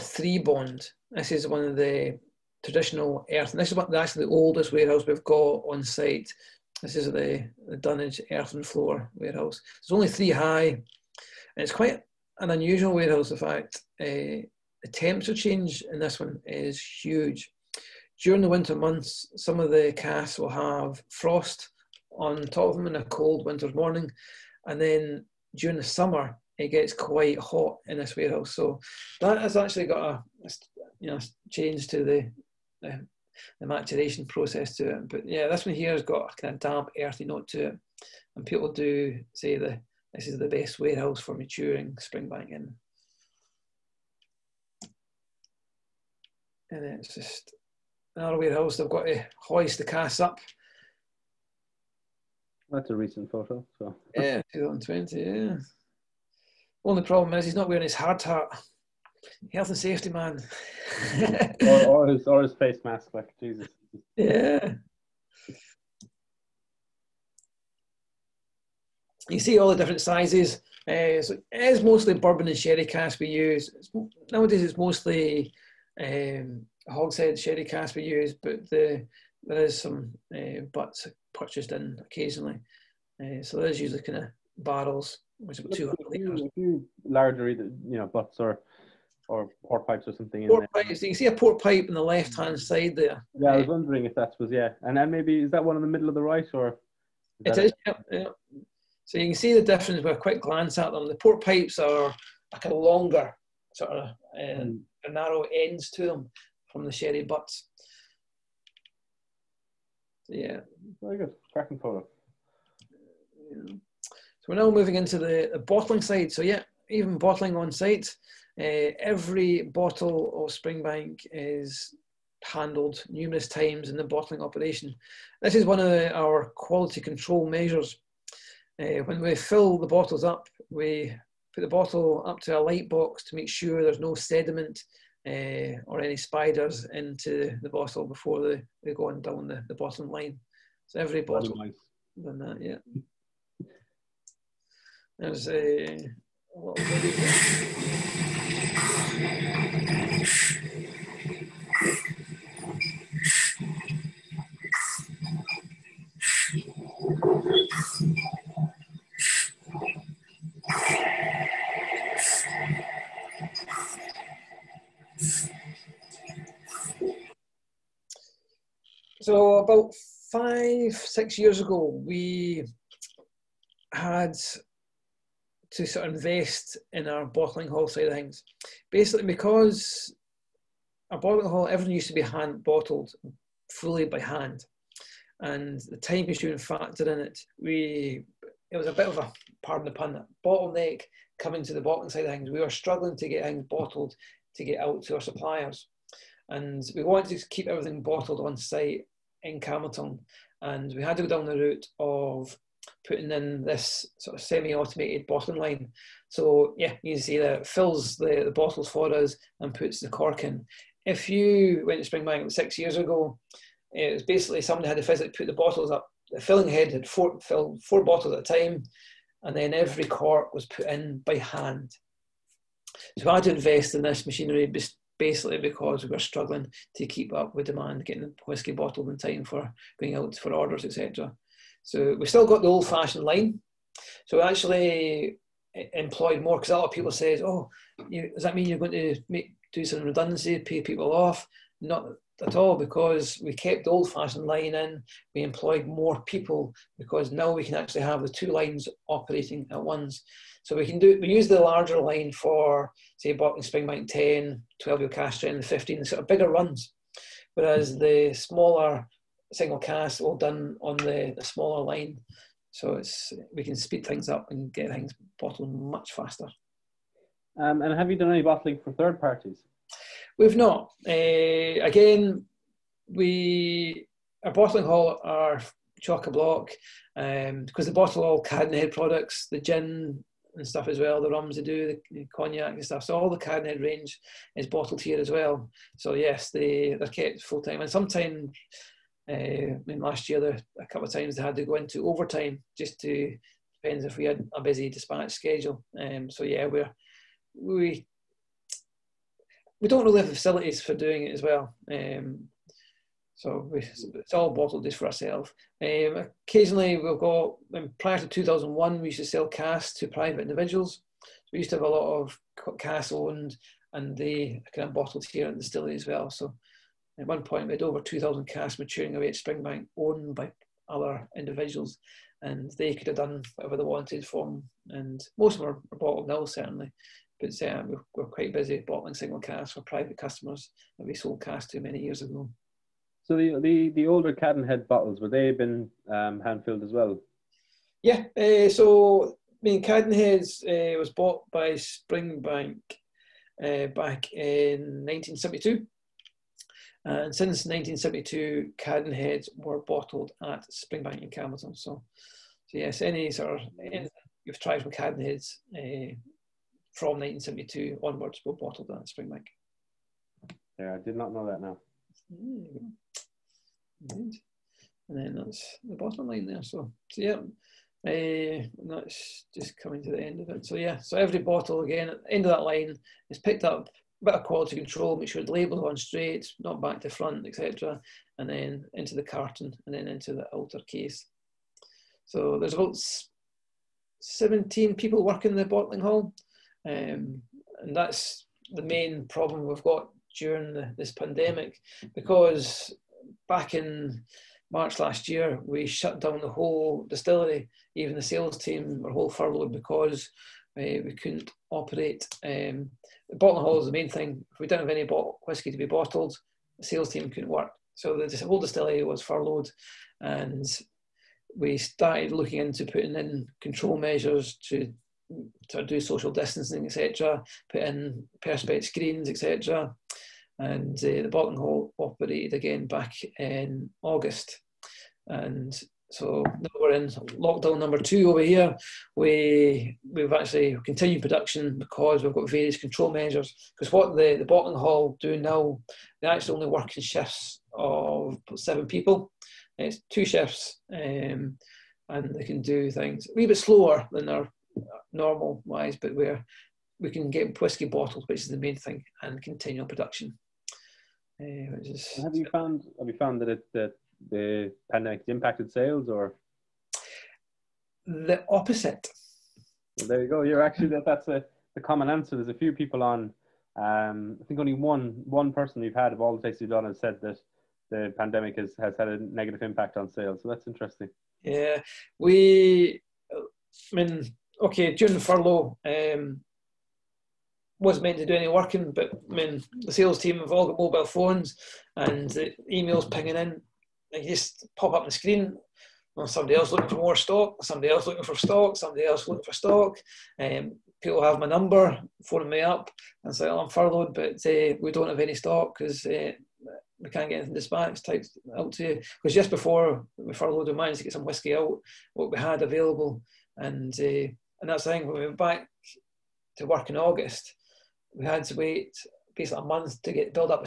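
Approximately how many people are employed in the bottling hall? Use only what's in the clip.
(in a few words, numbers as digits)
17.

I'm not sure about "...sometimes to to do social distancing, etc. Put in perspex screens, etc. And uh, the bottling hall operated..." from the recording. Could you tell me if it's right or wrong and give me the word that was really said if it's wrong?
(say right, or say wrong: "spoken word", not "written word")
wrong: "measures", not "sometimes".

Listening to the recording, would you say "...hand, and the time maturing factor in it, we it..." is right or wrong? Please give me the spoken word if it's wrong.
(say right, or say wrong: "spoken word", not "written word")
wrong: "consuming", not "maturing".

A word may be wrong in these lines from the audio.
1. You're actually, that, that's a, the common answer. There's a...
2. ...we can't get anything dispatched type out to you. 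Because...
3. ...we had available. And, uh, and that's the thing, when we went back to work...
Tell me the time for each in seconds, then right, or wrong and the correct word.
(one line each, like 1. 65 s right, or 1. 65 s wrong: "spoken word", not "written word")
1. 460 s right
2. 496 s right
3. 502 s right.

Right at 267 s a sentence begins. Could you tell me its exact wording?
Um, and have you done any bottling for third parties?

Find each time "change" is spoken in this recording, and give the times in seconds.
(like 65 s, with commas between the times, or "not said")
15 s, 31 s.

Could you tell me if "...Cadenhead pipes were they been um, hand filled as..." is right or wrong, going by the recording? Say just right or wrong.
wrong.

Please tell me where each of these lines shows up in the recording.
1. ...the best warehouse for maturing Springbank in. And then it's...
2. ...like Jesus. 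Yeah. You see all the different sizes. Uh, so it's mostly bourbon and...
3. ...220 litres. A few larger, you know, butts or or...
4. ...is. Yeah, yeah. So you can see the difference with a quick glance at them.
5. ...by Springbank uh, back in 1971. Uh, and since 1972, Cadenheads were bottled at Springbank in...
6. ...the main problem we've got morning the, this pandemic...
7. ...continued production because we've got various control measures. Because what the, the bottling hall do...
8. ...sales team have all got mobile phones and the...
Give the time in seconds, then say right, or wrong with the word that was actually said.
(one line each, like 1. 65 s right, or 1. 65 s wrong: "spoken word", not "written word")
1. 40 s right
2. 63 s right
3. 85 s wrong: "200", not "220"
4. 97 s right
5. 341 s wrong: "1972", not "1971"
6. 388 s wrong: "during", not "morning"
7. 430 s right
8. 479 s right.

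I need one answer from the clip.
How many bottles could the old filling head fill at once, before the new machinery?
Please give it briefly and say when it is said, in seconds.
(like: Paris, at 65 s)
4, at 217 s.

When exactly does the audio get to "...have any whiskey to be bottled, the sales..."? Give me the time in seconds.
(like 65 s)
404 s.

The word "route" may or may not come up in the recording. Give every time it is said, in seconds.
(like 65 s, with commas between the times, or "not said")
201 s.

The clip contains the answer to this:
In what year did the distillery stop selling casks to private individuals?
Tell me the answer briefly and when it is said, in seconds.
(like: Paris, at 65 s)
2001, at 308 s.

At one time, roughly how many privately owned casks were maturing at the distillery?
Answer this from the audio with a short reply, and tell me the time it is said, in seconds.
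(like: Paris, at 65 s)
over 2,000, at 317 s.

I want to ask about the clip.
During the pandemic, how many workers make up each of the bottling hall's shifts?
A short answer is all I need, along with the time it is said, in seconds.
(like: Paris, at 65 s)
7, at 438 s.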